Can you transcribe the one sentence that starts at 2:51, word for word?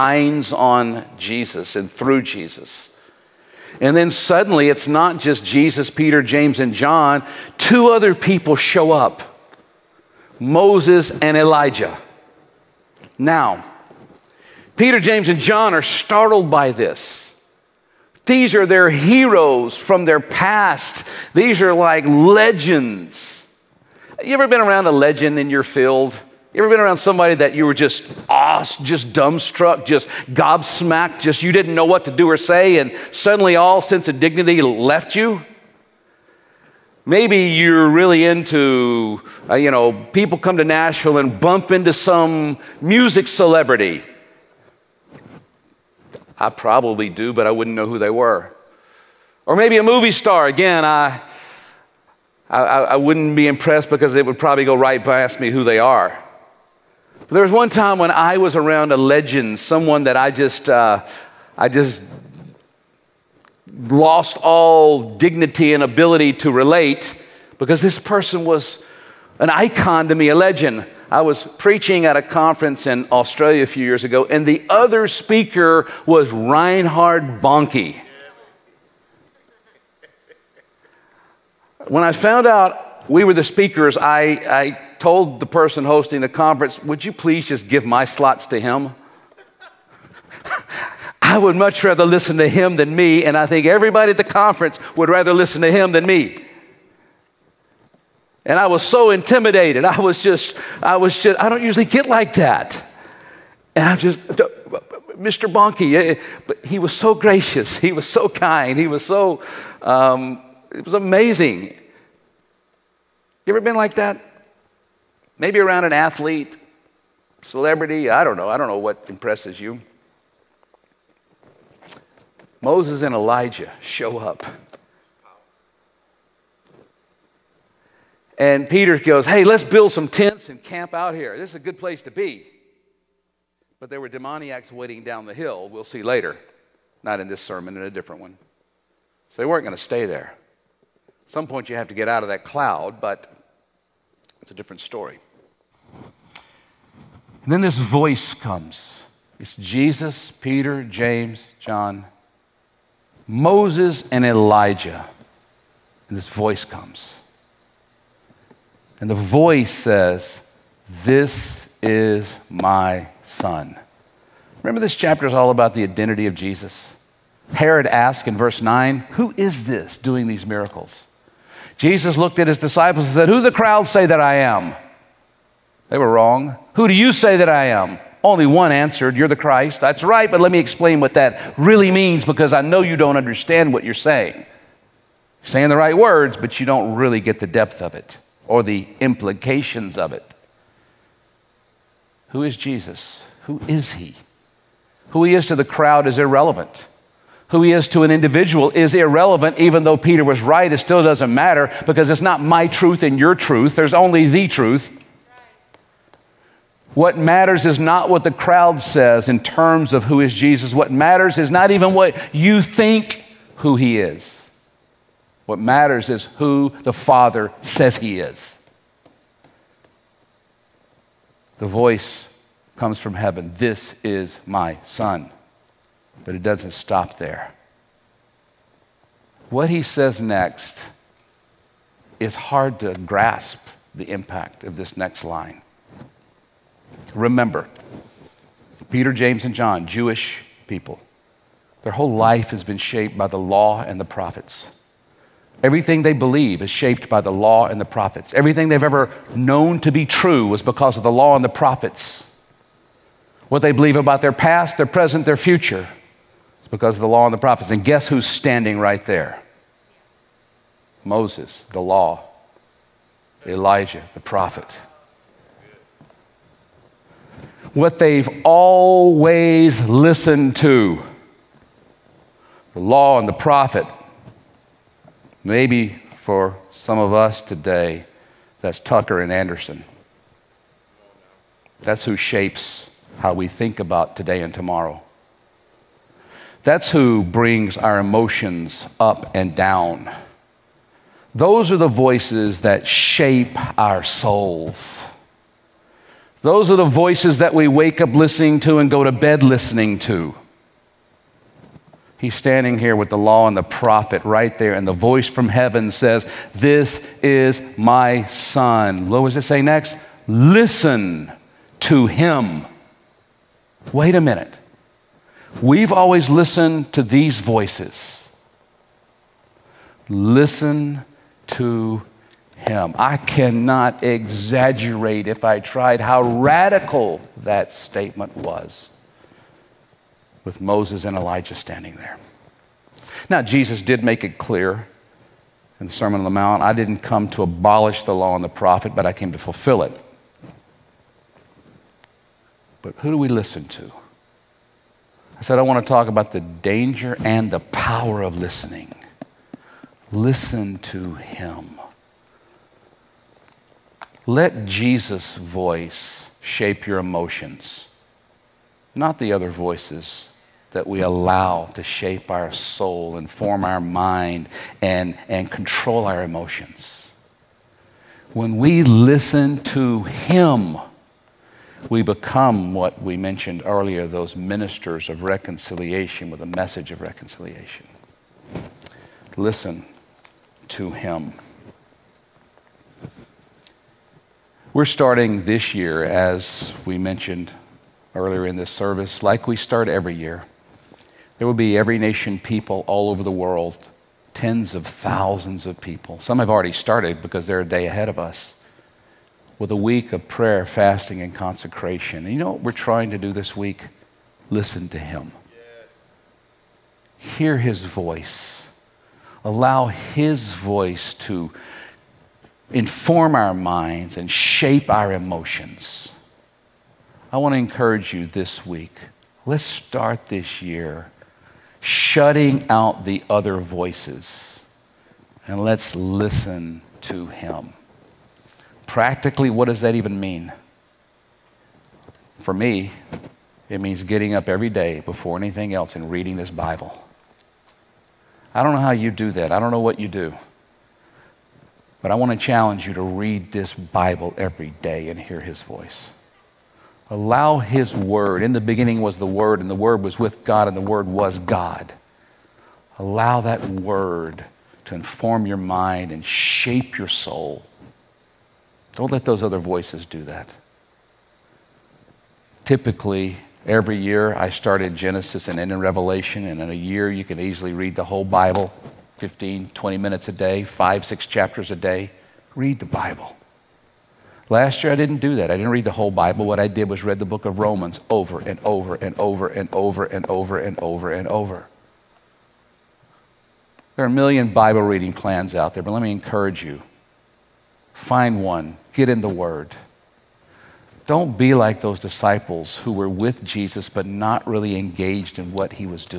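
Jesus looked at his disciples and said, Who the crowd say that I am?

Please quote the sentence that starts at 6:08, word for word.
When we listen to Him, we become what we mentioned earlier those ministers of reconciliation with a message of reconciliation.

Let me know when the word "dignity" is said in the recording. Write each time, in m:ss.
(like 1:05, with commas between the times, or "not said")
0:34, 1:05.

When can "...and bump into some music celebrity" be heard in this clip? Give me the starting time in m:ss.
0:41.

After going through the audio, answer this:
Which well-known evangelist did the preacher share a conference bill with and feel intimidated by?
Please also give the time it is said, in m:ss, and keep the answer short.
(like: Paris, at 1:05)
Reinhard Bonnke, at 1:16.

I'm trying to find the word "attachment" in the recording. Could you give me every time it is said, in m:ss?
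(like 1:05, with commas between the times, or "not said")
not said.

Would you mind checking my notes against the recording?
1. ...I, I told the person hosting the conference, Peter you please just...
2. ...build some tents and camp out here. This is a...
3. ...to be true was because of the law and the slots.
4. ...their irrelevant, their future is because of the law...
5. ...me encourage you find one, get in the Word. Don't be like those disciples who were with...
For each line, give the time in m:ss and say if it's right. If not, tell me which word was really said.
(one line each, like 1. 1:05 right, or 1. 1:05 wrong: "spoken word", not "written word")
1. 1:23 wrong: "Would", not "Peter"
2. 2:09 right
3. 4:09 wrong: "prophets", not "slots"
4. 4:14 wrong: "present", not "irrelevant"
5. 8:06 right.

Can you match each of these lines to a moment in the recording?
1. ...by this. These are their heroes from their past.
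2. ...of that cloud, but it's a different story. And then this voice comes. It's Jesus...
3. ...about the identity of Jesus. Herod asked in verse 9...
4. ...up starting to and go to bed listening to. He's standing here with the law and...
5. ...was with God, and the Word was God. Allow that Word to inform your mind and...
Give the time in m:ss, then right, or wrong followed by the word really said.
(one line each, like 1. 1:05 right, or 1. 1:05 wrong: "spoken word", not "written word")
1. 0:16 right
2. 2:22 right
3. 2:45 right
4. 4:58 wrong: "listening", not "starting"
5. 7:30 right.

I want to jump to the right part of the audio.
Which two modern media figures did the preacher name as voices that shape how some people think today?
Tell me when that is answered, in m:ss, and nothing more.
4:38.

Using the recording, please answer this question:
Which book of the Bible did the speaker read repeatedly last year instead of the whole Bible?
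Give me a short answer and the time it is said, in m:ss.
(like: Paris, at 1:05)
Romans, at 7:57.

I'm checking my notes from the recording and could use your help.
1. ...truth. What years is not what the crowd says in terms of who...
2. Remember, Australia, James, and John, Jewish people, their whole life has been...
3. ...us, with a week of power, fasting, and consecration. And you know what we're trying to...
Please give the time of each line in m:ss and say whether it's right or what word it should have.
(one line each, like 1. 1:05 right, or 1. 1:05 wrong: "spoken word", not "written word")
1. 3:24 wrong: "matters", not "years"
2. 3:57 wrong: "Peter", not "Australia"
3. 6:38 wrong: "prayer", not "power".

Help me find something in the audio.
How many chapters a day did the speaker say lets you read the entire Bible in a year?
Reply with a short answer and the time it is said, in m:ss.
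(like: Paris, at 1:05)
5 or 6, at 7:50.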